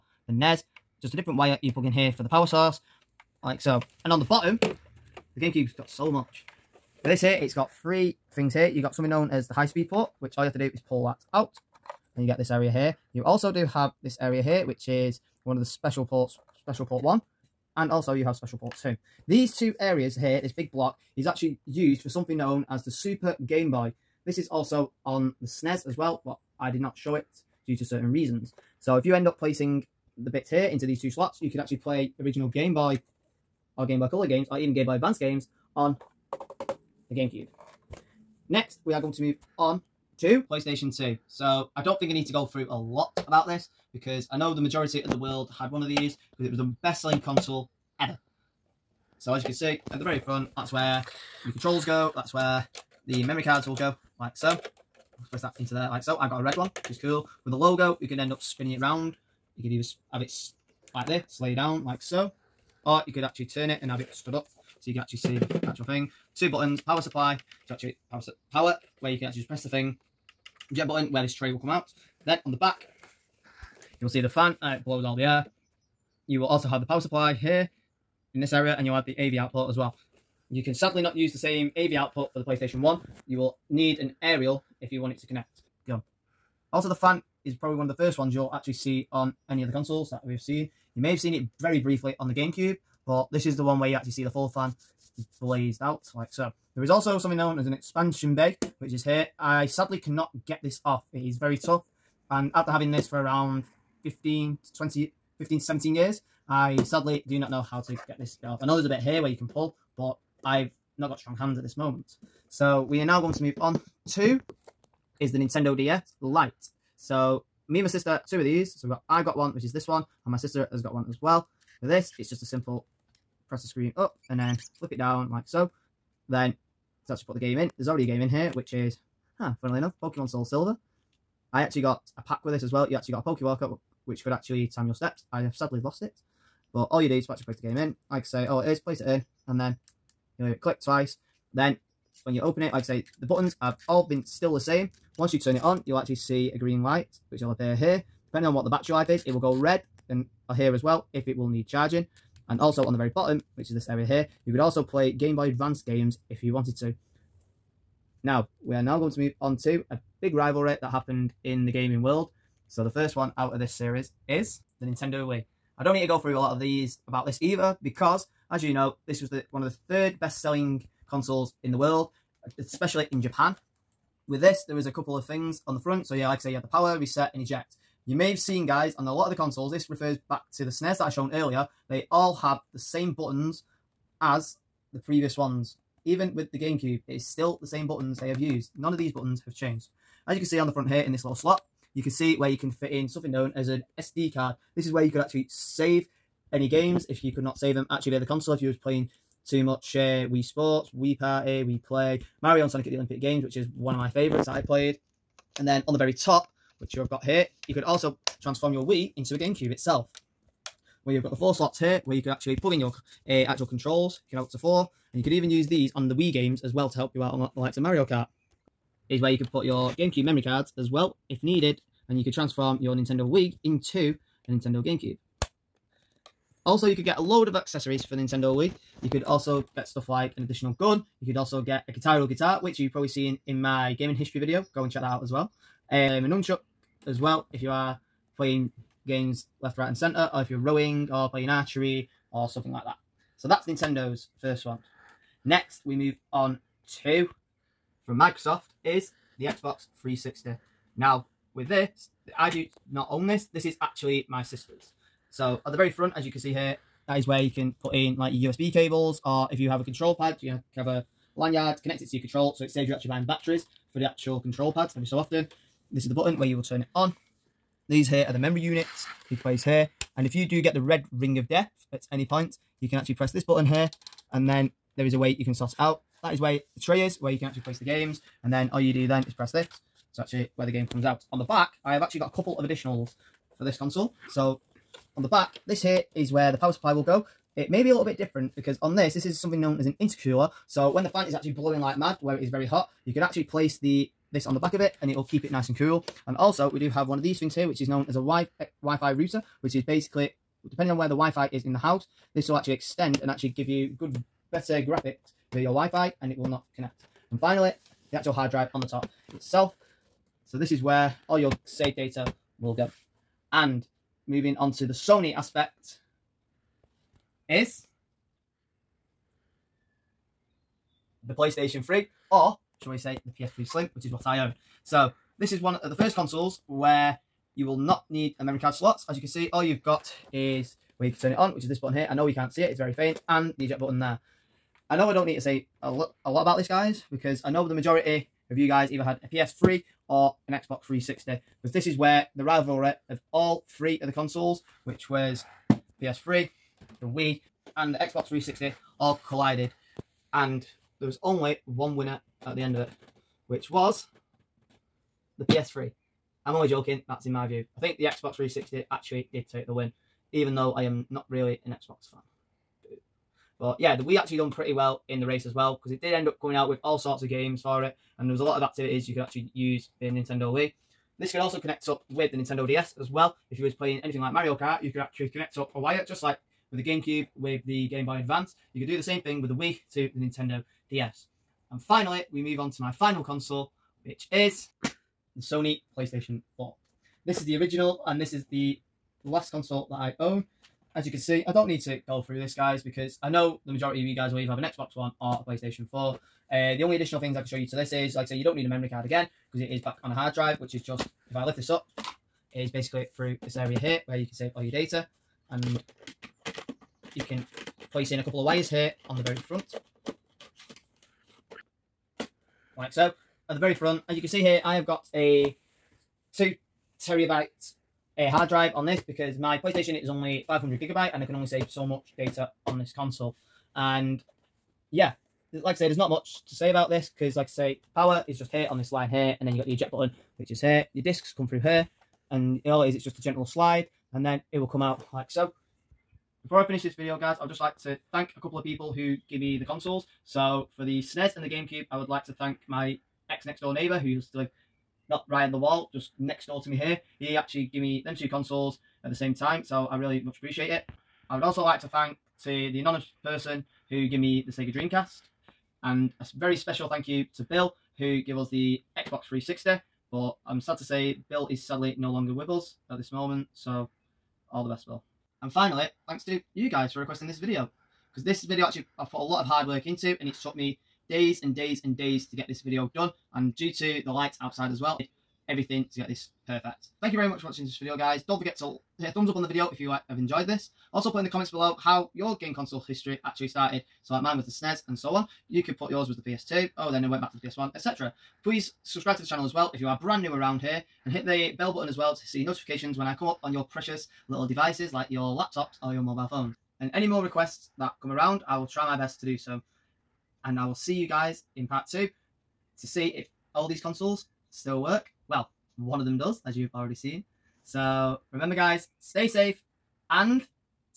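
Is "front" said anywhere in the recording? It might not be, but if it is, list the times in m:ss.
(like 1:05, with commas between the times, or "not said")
0:50, 2:55, 3:10, 4:15, 6:49, 6:53.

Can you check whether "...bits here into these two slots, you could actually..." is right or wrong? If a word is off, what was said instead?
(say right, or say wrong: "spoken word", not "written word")
right.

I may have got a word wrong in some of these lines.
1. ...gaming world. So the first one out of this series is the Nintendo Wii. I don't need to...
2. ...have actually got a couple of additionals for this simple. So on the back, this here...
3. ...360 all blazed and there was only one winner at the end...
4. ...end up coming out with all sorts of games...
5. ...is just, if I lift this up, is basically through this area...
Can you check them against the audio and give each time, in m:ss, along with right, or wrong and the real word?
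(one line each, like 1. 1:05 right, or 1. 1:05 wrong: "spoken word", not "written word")
1. 2:41 right
2. 4:41 wrong: "console", not "simple"
3. 5:48 wrong: "collided", not "blazed"
4. 6:06 right
5. 6:40 right.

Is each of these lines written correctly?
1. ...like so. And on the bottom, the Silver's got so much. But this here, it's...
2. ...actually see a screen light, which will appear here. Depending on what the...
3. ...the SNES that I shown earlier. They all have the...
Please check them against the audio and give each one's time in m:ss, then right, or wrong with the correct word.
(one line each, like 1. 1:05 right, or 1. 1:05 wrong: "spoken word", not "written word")
1. 0:03 wrong: "GameCube", not "Silver"
2. 2:25 wrong: "green", not "screen"
3. 3:00 right.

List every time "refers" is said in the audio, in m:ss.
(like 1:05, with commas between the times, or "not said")
2:59.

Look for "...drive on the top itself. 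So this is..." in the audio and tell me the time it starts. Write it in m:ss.
5:08.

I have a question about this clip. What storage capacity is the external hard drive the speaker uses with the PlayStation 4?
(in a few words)
2 terabytes.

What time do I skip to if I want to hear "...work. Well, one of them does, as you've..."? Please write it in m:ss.
8:24.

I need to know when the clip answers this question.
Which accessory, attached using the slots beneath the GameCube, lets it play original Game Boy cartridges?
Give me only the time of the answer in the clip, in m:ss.
0:22.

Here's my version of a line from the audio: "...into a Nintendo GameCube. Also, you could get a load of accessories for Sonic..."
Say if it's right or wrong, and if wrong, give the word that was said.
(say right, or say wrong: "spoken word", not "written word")
wrong: "Nintendo", not "Sonic".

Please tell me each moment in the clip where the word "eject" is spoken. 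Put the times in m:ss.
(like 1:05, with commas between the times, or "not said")
2:57, 5:33, 7:09.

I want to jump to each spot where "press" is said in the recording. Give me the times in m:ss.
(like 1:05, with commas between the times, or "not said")
1:09, 2:03, 4:33, 4:39.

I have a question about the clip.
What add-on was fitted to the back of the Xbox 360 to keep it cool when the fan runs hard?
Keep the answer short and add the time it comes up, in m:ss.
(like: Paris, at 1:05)
Intercooler, at 4:49.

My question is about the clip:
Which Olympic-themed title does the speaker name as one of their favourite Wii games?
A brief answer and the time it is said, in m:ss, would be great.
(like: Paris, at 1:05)
Mario and Sonic at the Olympic Games, at 3:22.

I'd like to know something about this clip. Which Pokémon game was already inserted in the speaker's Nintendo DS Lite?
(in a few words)
Pokemon Soul Silver.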